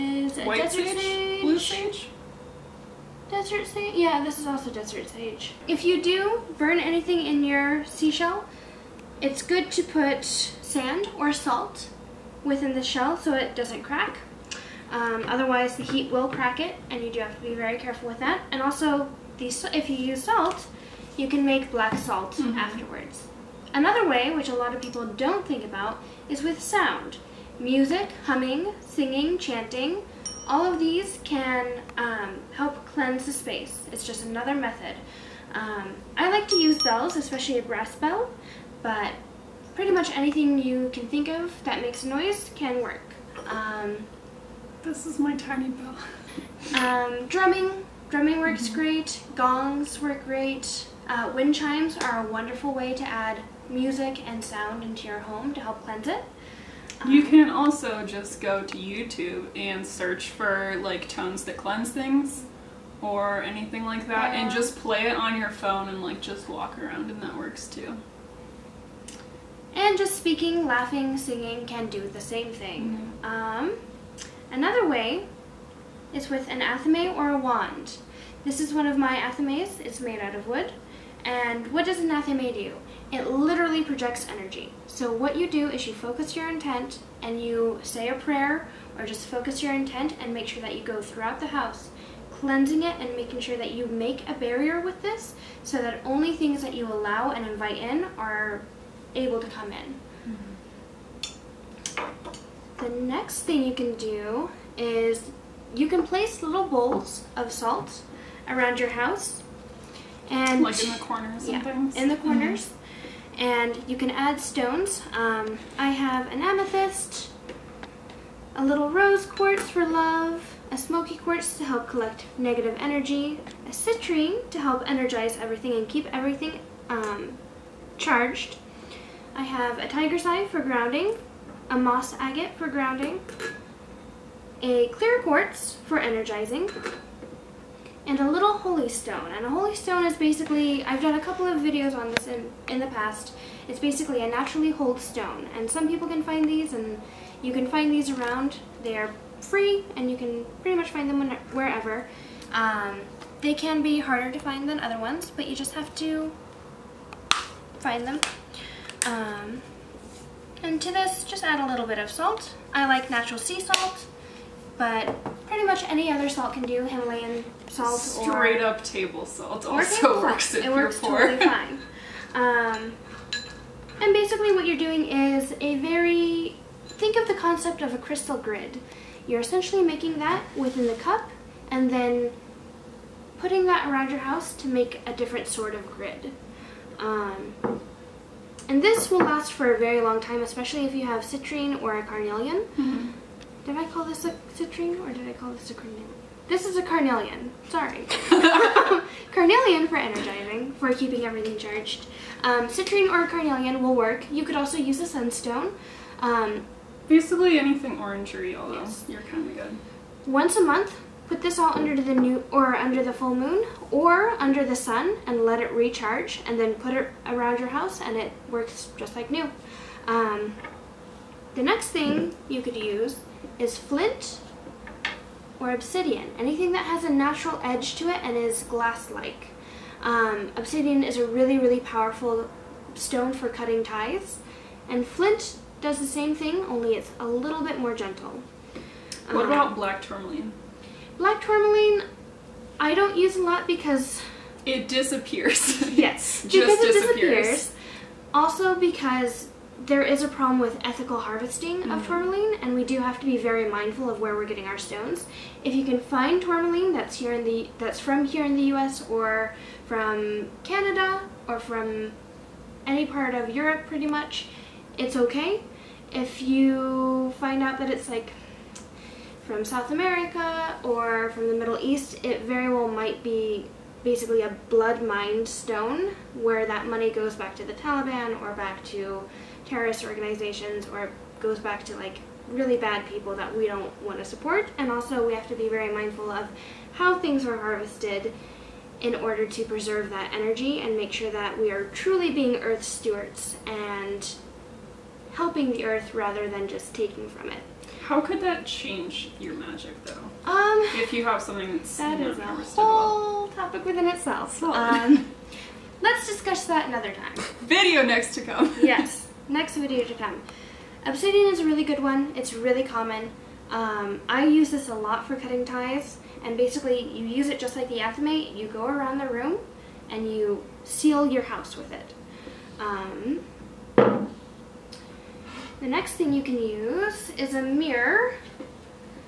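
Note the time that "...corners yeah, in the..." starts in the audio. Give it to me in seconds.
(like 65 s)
111 s.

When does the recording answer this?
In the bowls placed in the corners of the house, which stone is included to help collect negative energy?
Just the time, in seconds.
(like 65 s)
120 s.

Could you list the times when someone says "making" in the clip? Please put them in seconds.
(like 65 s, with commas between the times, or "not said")
93 s, 179 s.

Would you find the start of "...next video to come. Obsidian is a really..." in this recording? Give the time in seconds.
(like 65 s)
309 s.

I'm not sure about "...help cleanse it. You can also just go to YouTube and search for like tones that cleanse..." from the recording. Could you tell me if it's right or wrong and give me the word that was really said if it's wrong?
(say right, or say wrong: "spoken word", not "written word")
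right.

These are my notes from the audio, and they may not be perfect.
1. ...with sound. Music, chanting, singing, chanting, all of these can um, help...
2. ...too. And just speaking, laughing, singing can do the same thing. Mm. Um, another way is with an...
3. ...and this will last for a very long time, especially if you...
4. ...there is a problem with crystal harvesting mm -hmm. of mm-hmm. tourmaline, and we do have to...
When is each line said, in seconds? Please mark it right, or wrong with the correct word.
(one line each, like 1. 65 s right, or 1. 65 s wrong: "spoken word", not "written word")
1. 26 s wrong: "humming", not "chanting"
2. 67 s right
3. 188 s right
4. 249 s wrong: "ethical", not "crystal".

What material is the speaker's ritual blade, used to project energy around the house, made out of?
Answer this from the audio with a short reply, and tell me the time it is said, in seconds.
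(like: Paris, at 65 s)
wood, at 80 s.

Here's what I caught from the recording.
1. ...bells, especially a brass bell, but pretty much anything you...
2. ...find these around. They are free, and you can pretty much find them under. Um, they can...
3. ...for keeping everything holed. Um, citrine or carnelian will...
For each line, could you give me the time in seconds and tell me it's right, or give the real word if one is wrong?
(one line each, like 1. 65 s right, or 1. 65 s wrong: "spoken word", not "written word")
1. 36 s right
2. 147 s wrong: "wherever", not "under"
3. 200 s wrong: "charged", not "holed".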